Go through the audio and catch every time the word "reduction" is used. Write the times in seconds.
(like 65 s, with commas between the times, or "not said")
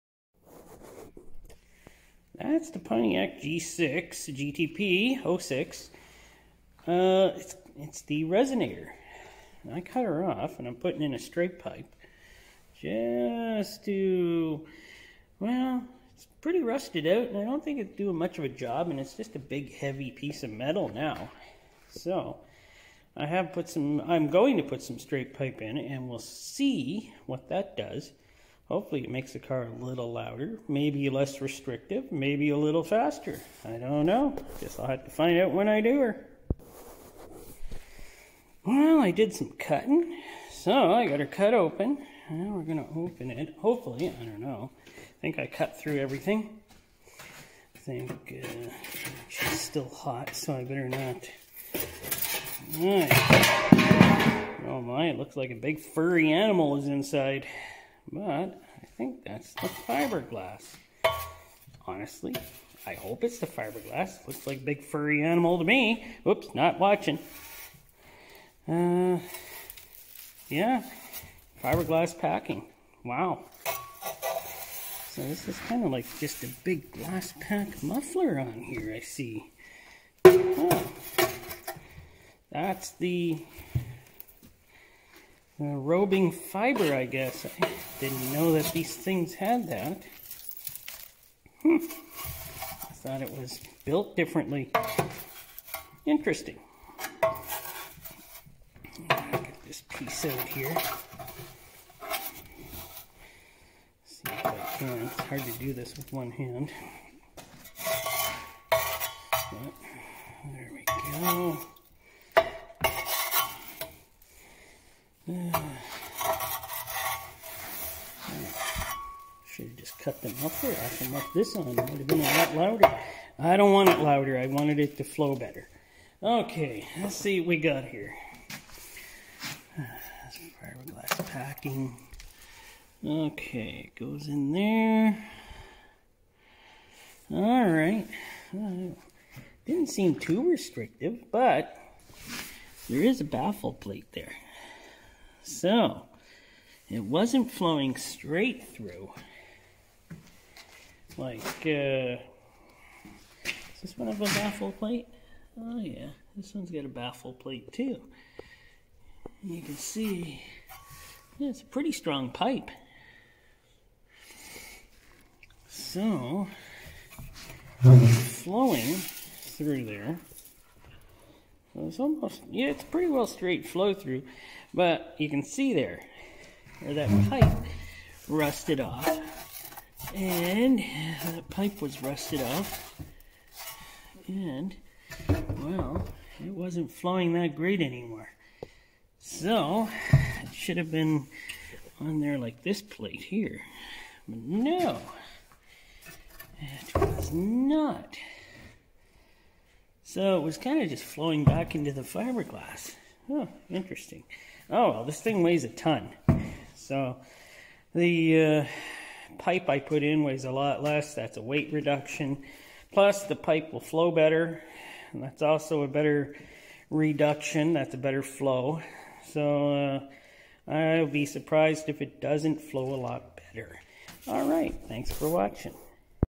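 211 s, 216 s.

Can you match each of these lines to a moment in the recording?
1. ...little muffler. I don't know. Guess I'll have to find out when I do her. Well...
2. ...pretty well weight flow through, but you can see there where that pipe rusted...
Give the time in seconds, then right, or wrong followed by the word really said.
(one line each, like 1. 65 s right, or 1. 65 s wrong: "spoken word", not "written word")
1. 32 s wrong: "faster", not "muffler"
2. 172 s wrong: "straight", not "weight".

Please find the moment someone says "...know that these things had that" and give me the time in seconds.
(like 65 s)
88 s.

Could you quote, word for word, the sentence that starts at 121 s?
It would have been a lot louder.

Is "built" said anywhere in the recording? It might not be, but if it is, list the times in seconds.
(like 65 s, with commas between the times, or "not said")
93 s.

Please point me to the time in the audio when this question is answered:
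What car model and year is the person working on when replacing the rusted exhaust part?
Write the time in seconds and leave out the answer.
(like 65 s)
2 s.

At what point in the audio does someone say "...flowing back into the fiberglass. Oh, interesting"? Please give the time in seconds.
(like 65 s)
201 s.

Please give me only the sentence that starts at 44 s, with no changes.
I think I cut through everything.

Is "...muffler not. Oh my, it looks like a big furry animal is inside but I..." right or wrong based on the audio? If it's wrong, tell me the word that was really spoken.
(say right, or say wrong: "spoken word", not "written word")
wrong: "better", not "muffler".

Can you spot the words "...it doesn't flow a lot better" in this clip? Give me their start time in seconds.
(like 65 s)
222 s.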